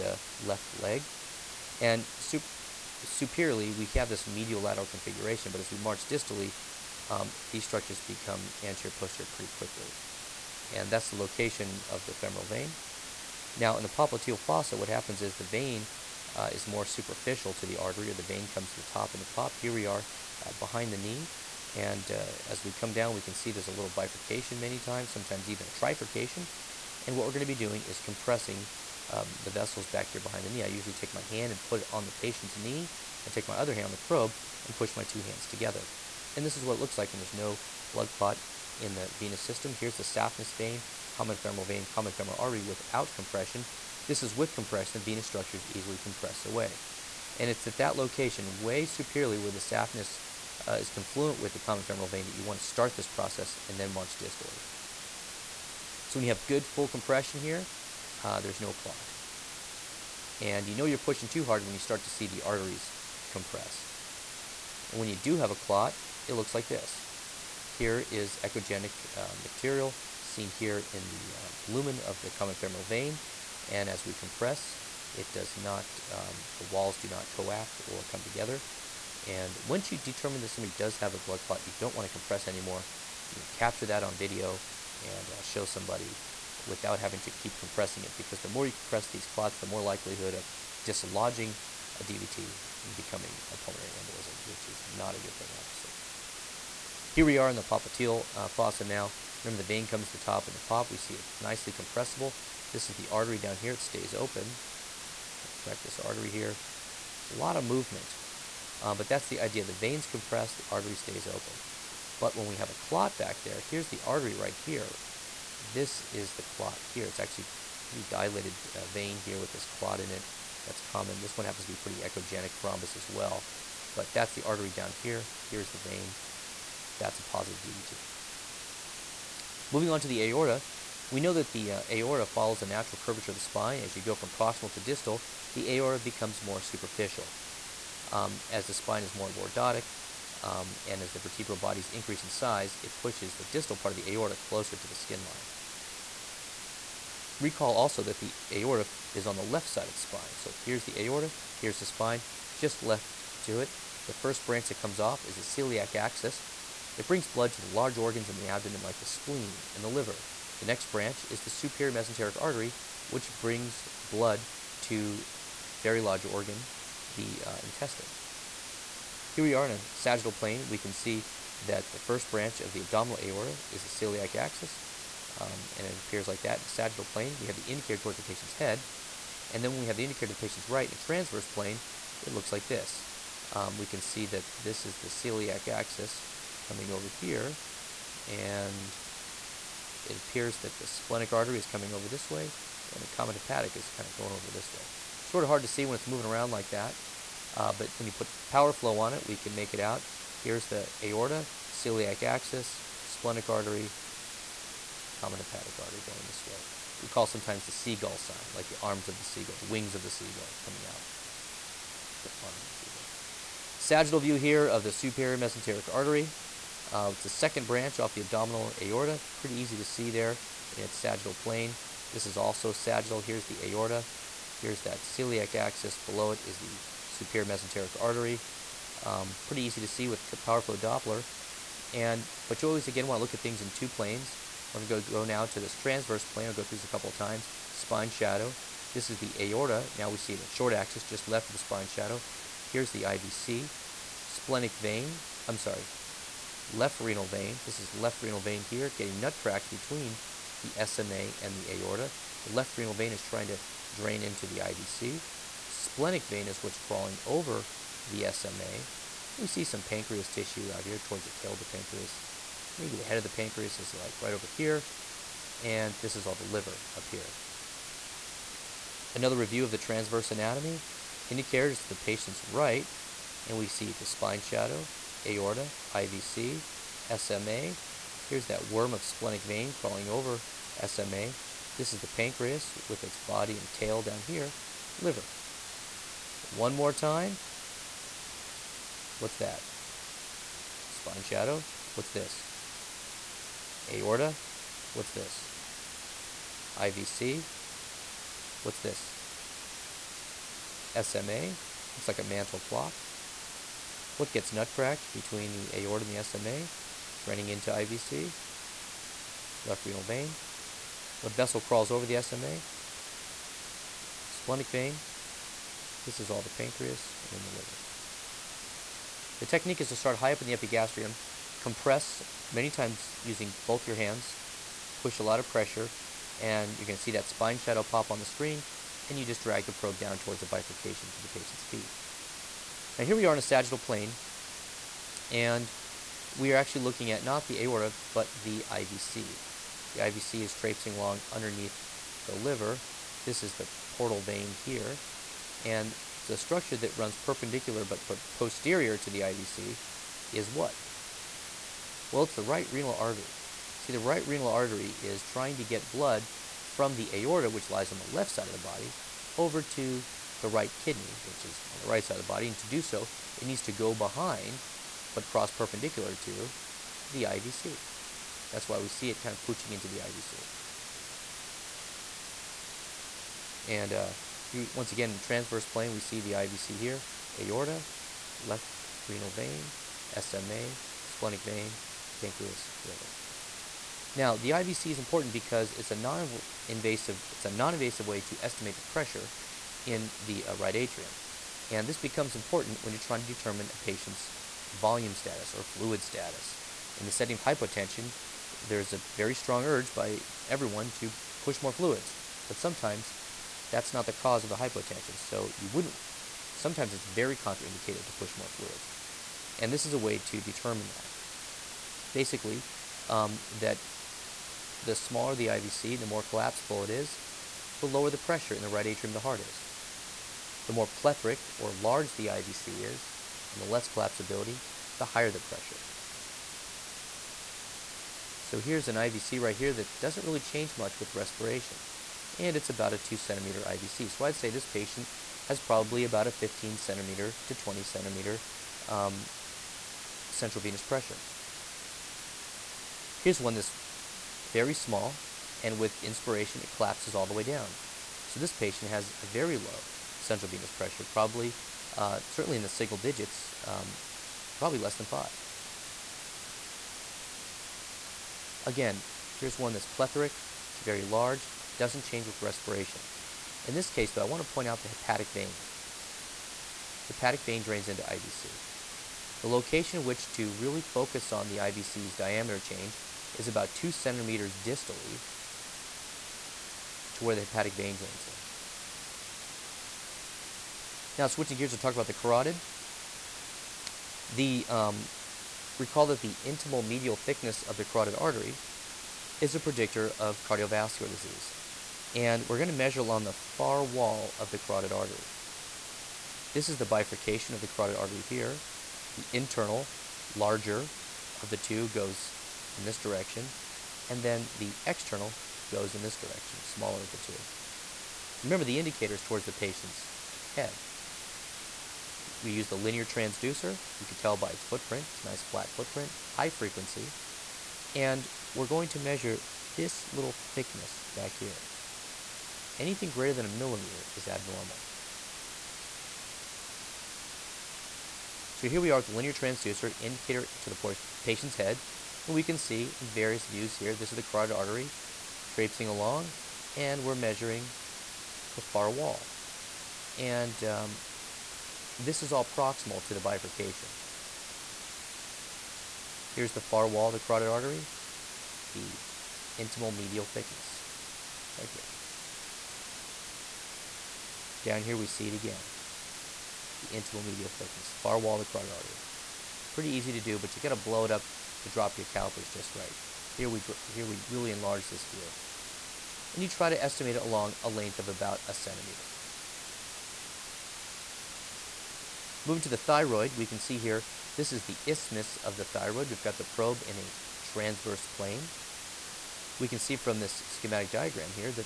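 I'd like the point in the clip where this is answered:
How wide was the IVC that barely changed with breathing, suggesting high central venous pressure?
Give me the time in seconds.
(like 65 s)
432 s.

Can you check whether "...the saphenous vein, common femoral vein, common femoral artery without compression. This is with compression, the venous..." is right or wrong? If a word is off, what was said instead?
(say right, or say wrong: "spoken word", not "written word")
right.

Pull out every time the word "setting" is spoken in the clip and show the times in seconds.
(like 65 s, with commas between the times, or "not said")
397 s.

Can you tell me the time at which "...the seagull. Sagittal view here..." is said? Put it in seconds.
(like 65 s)
212 s.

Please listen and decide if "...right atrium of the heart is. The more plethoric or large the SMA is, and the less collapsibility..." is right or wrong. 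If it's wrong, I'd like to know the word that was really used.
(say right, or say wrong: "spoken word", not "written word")
wrong: "IVC", not "SMA".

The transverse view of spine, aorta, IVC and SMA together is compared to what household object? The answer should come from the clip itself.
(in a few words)
Mantle clock.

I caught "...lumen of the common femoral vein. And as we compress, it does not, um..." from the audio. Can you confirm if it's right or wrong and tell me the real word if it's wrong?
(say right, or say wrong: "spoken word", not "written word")
right.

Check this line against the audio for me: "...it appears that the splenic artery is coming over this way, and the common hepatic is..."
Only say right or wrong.
right.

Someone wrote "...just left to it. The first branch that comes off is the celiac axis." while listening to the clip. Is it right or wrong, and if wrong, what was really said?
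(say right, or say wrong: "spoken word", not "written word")
right.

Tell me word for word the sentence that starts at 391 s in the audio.
And this becomes important when you're trying to determine a patient's volume status or fluid status.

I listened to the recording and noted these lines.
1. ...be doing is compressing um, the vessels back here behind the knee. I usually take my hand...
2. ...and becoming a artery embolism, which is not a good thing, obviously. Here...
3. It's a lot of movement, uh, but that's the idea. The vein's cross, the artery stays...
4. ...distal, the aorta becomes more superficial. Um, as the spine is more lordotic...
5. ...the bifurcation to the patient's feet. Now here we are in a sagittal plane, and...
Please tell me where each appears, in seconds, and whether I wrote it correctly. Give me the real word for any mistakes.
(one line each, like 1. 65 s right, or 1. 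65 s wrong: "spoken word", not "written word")
1. 27 s right
2. 92 s wrong: "pulmonary", not "artery"
3. 107 s wrong: "compress", not "cross"
4. 134 s right
5. 330 s right.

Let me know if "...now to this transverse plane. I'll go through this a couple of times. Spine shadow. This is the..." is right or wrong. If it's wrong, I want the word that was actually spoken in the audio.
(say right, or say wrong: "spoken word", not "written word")
right.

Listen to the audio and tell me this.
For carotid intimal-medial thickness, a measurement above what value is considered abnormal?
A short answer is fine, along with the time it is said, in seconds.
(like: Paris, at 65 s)
1 millimeter, at 523 s.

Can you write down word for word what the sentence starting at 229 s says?
Um, pretty easy to see with power flow Doppler.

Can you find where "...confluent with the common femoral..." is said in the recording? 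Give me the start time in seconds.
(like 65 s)
50 s.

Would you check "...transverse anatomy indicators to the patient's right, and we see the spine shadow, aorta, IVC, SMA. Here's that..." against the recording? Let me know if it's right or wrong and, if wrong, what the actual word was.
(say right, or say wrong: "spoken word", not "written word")
right.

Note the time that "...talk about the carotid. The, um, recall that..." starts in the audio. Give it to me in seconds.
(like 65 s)
481 s.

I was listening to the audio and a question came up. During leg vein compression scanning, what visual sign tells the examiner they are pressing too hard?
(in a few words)
Arteries compress.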